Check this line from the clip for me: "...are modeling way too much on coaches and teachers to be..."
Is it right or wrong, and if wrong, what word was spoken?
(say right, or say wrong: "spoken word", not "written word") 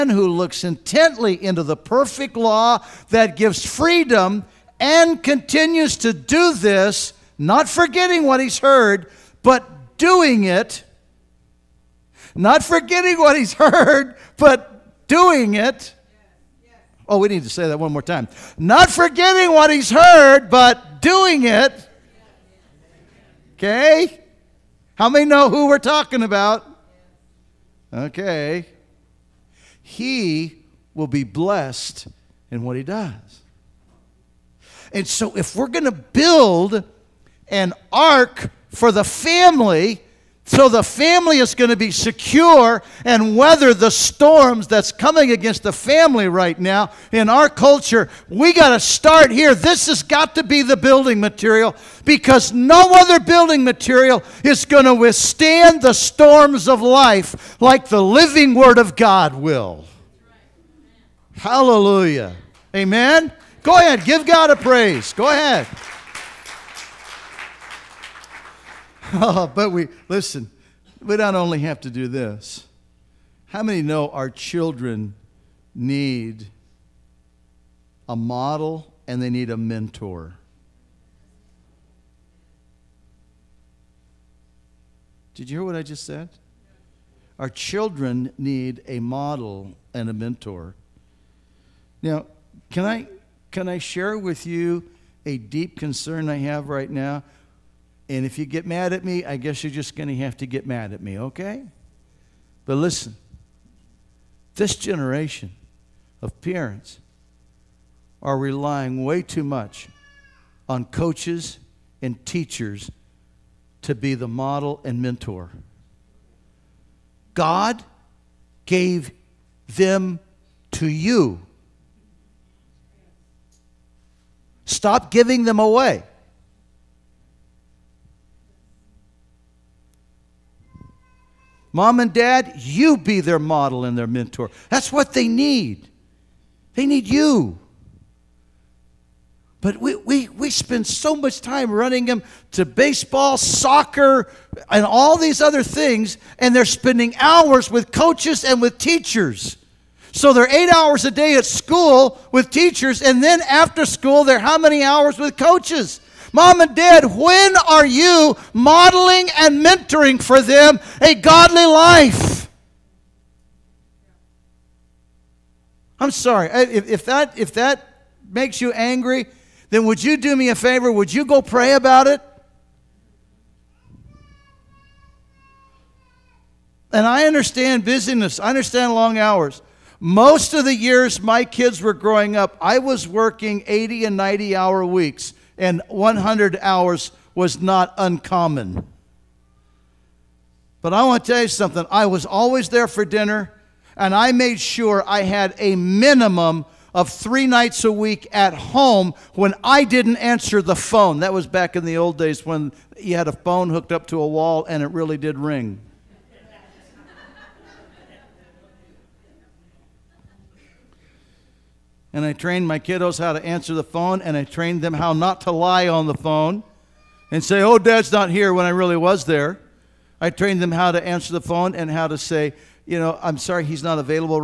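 wrong: "relying", not "modeling".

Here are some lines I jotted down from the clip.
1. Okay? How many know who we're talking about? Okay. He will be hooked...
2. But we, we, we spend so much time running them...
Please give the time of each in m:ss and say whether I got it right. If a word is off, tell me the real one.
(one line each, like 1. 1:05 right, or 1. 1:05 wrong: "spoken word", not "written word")
1. 0:23 wrong: "blessed", not "hooked"
2. 2:19 right.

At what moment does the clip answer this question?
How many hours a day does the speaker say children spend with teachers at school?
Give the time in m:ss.
2:30.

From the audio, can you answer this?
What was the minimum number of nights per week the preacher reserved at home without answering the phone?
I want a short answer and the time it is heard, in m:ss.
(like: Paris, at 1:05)
3, at 3:17.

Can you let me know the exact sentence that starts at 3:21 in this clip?
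That was back in the old days when you had a phone hooked up to a wall and it really did ring.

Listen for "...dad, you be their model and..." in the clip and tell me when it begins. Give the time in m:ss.
2:12.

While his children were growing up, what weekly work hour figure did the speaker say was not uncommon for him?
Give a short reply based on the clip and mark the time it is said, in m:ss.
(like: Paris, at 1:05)
100, at 3:05.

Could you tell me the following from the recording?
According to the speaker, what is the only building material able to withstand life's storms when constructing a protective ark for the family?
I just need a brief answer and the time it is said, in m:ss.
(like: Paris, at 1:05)
The living Word of God, at 0:58.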